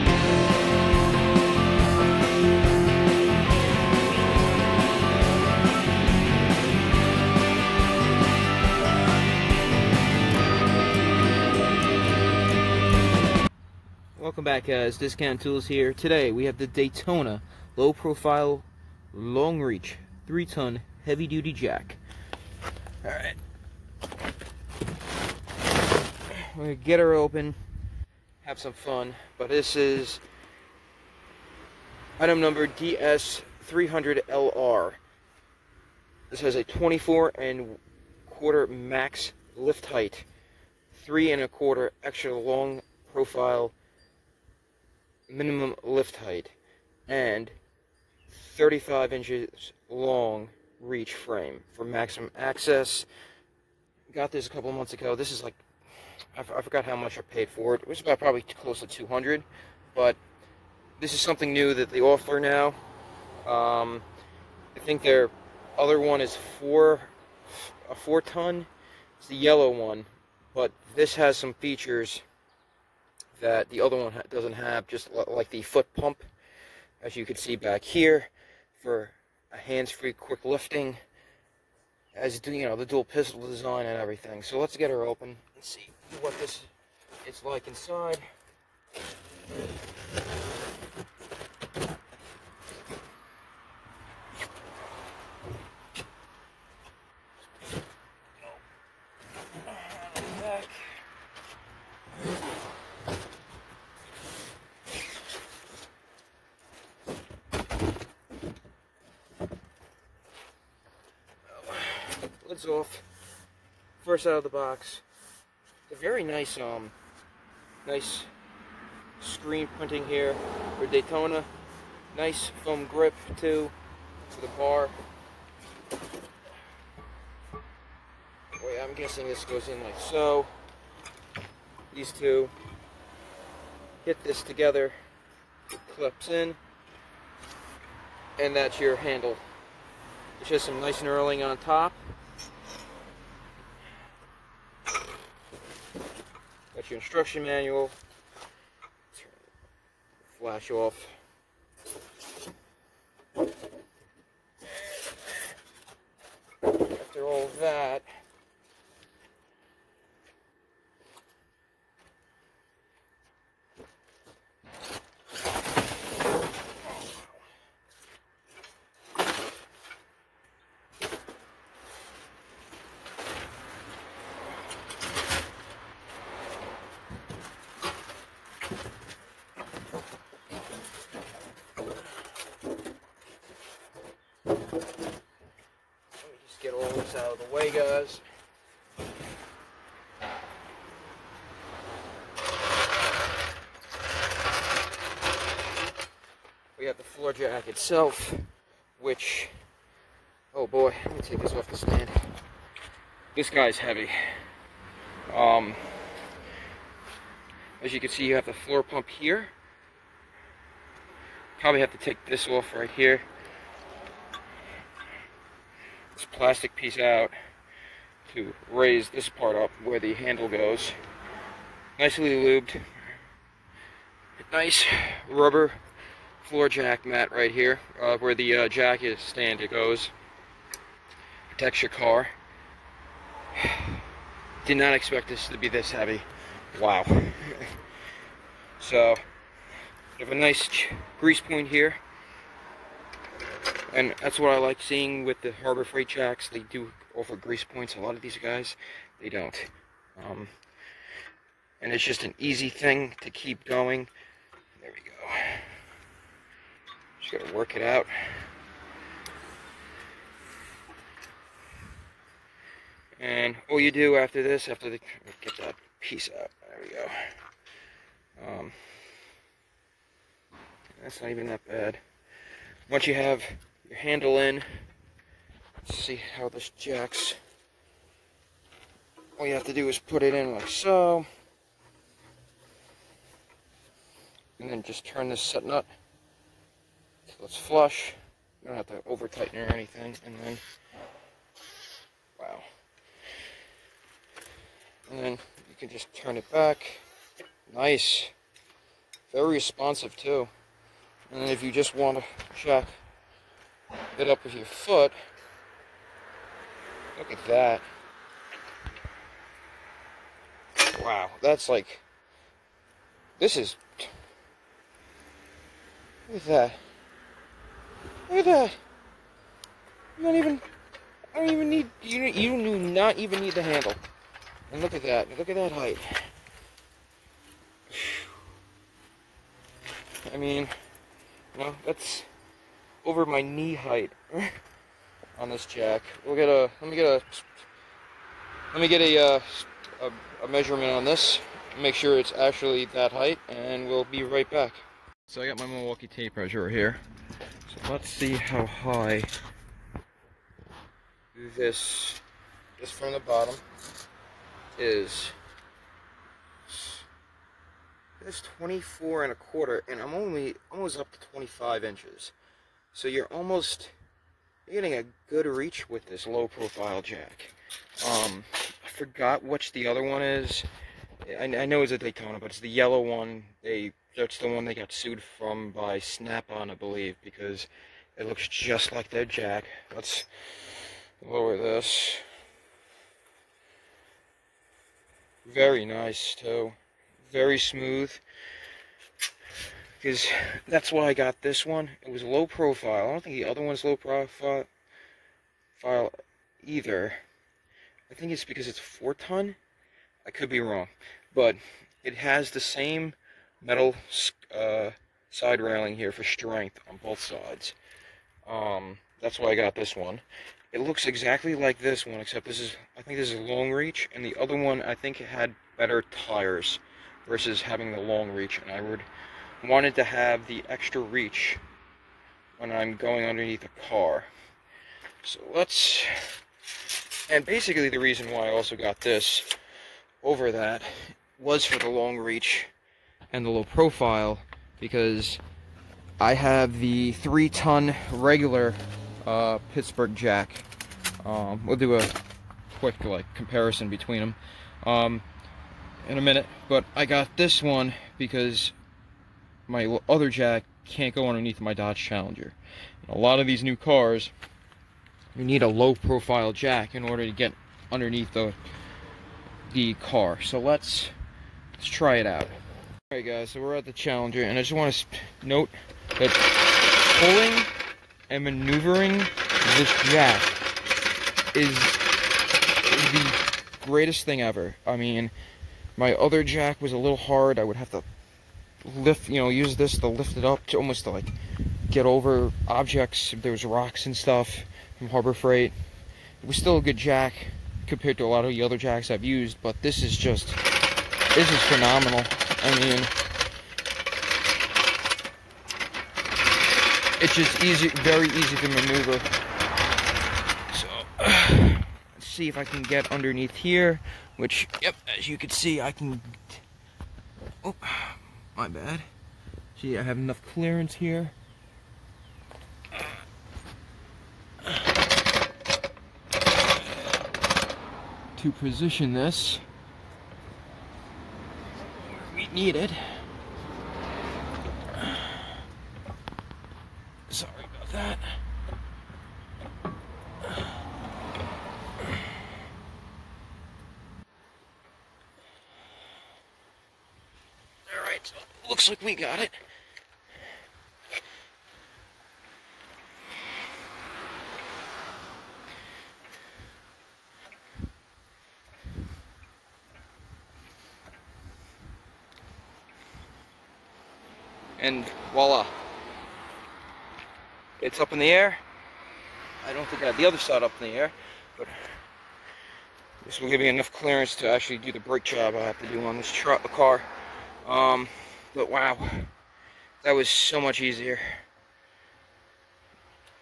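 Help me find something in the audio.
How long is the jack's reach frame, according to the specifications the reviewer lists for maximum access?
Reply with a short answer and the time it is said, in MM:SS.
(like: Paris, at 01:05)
35 inches, at 00:48.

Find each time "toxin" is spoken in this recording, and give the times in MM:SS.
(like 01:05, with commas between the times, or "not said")
not said.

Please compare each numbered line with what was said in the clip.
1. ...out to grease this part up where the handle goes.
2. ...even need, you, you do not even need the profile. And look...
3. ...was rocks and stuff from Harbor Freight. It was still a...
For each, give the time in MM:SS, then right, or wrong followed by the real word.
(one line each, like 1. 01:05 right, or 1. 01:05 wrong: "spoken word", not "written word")
1. 03:36 wrong: "raise", not "grease"
2. 05:21 wrong: "handle", not "profile"
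3. 08:03 right.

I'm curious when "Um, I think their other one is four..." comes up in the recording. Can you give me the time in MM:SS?
01:03.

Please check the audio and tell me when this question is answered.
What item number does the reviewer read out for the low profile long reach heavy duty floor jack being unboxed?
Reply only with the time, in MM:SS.
00:32.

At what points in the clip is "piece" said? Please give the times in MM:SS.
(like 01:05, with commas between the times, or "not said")
03:36, 04:25.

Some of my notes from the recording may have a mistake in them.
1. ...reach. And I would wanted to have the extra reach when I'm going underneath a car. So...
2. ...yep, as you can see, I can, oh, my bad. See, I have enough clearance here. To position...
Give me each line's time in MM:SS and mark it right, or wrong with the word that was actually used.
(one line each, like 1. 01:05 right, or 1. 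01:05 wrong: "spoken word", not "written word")
1. 06:58 right
2. 08:24 right.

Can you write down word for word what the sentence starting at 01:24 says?
So let's get her open and see what this is like inside.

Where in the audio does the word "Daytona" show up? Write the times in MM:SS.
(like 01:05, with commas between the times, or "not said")
00:16, 02:00, 06:11.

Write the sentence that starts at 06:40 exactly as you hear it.
I could be wrong, but it has the same metal uh, side railing here for strength on both sides.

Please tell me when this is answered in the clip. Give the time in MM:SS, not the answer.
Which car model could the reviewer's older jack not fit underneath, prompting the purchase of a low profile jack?
07:31.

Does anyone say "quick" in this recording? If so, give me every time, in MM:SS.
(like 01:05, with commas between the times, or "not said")
01:20, 07:22.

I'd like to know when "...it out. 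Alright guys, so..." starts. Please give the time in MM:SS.
07:42.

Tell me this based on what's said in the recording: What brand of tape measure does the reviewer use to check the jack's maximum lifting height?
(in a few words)
Milwaukee.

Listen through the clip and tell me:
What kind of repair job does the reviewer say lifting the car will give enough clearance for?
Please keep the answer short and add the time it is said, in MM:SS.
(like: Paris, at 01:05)
Brake job, at 09:24.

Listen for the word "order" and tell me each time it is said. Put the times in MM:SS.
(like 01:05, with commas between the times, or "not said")
07:37.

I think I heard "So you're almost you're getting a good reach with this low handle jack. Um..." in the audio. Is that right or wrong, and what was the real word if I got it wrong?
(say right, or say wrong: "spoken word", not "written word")
wrong: "profile", not "handle".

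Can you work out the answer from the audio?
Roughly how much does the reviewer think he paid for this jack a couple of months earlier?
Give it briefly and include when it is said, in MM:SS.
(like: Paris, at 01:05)
About 200, at 00:58.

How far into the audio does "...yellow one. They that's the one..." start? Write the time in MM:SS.
06:12.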